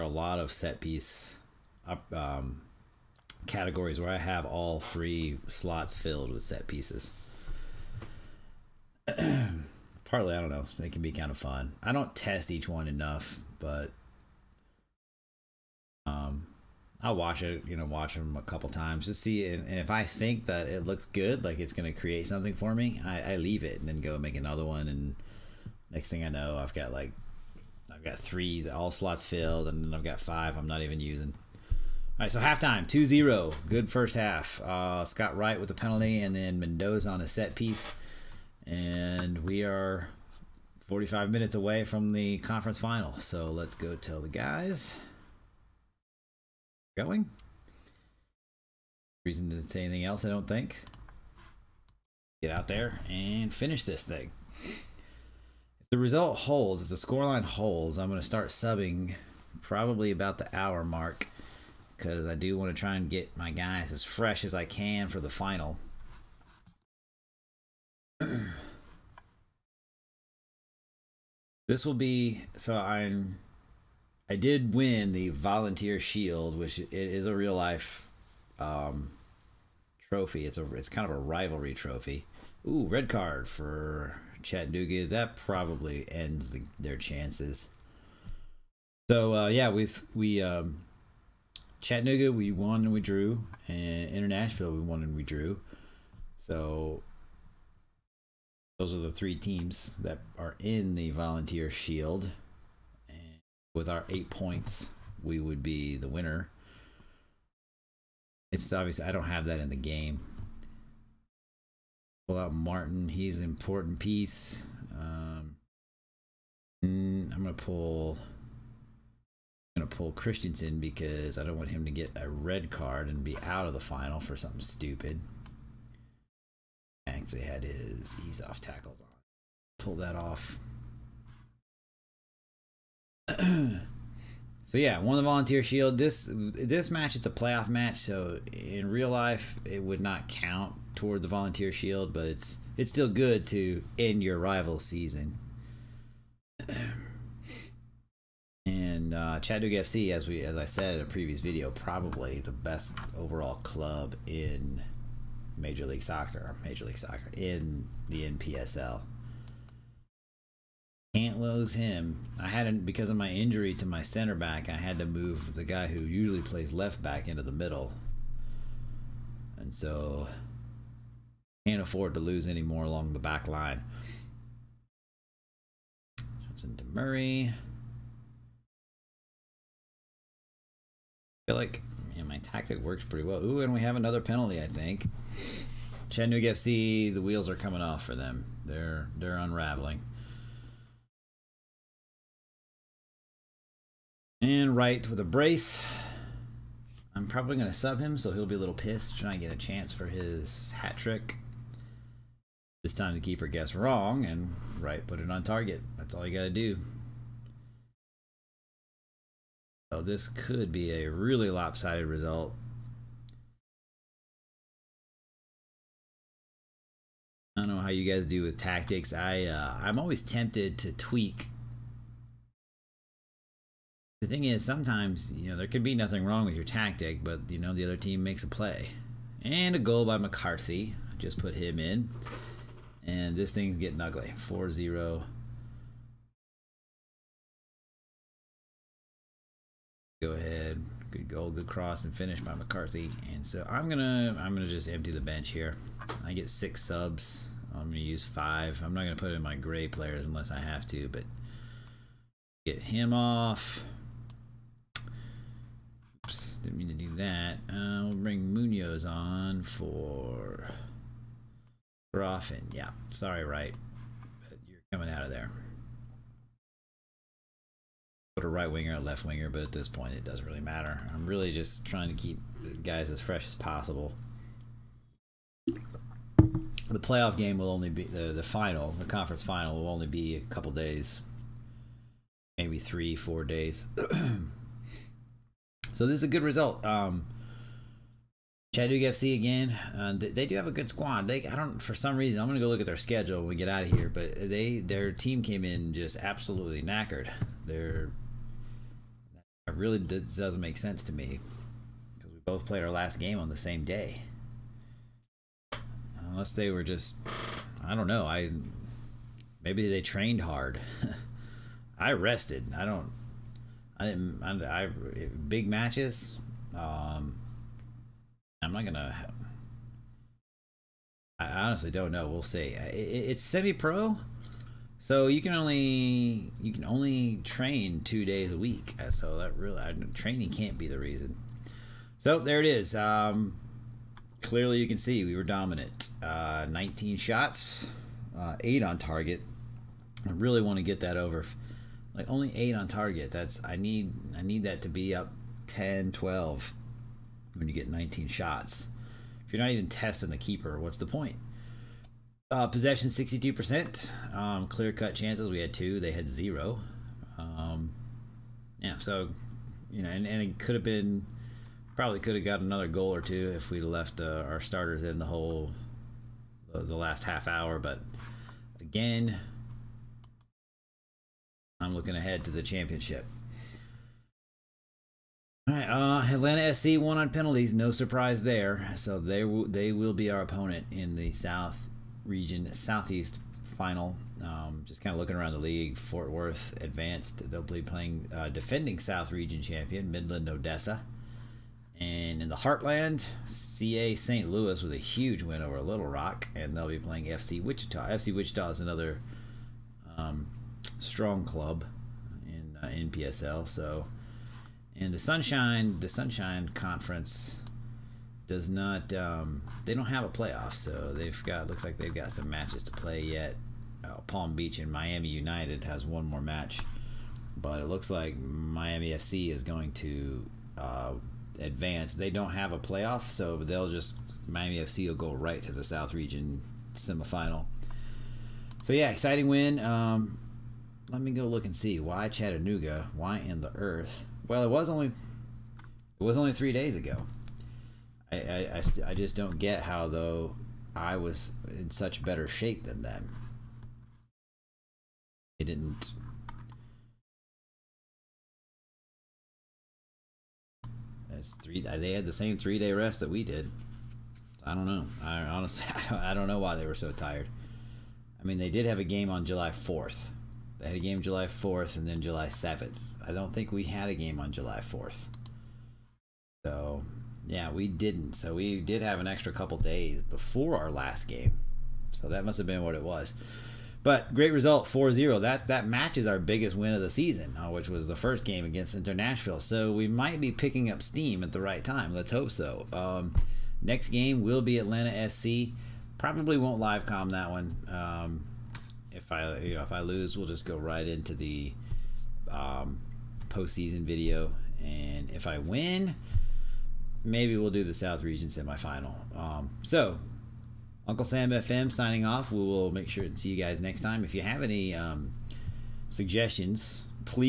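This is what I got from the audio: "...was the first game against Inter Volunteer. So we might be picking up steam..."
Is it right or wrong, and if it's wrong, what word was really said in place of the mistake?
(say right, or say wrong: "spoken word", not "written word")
wrong: "Nashville", not "Volunteer".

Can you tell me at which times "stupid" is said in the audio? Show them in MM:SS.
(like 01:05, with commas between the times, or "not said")
02:04.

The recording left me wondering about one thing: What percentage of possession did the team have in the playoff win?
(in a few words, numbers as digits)
62%.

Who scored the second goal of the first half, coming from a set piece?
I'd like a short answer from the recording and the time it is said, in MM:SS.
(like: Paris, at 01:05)
Mendoza, at 00:36.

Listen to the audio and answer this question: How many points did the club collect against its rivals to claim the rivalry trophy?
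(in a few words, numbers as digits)
8.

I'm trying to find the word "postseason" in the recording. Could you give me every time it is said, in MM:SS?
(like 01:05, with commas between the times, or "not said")
08:13.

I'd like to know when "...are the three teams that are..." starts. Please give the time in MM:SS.
01:38.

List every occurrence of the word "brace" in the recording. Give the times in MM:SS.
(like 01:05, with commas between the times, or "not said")
03:15.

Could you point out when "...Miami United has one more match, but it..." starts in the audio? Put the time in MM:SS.
06:54.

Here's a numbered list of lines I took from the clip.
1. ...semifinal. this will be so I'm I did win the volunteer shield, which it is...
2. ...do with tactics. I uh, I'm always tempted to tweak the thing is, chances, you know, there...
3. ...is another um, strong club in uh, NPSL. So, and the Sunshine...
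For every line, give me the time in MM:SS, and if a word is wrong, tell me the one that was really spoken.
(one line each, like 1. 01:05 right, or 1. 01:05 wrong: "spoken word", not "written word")
1. 01:05 wrong: "final", not "semifinal"
2. 03:38 wrong: "sometimes", not "chances"
3. 06:38 right.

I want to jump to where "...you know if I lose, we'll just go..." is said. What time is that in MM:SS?
08:09.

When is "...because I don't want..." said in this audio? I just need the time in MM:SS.
02:00.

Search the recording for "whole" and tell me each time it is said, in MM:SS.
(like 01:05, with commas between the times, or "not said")
06:05.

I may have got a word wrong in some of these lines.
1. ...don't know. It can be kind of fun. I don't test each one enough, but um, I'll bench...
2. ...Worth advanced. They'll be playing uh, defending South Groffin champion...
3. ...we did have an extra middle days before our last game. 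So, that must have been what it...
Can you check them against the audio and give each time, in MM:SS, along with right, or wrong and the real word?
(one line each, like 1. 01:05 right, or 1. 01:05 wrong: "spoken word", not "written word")
1. 00:10 wrong: "watch", not "bench"
2. 06:26 wrong: "Region", not "Groffin"
3. 07:48 wrong: "couple", not "middle".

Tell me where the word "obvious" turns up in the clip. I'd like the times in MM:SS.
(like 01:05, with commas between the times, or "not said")
01:48.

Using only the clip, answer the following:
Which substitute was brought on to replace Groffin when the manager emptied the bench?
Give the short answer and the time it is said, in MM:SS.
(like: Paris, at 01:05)
Munoz, at 04:18.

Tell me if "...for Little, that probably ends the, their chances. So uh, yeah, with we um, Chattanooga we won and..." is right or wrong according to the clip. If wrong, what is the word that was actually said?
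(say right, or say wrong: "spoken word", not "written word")
wrong: "Chattanooga", not "Little".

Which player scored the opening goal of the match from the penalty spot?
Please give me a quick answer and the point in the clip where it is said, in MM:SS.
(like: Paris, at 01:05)
Scott Wright, at 00:35.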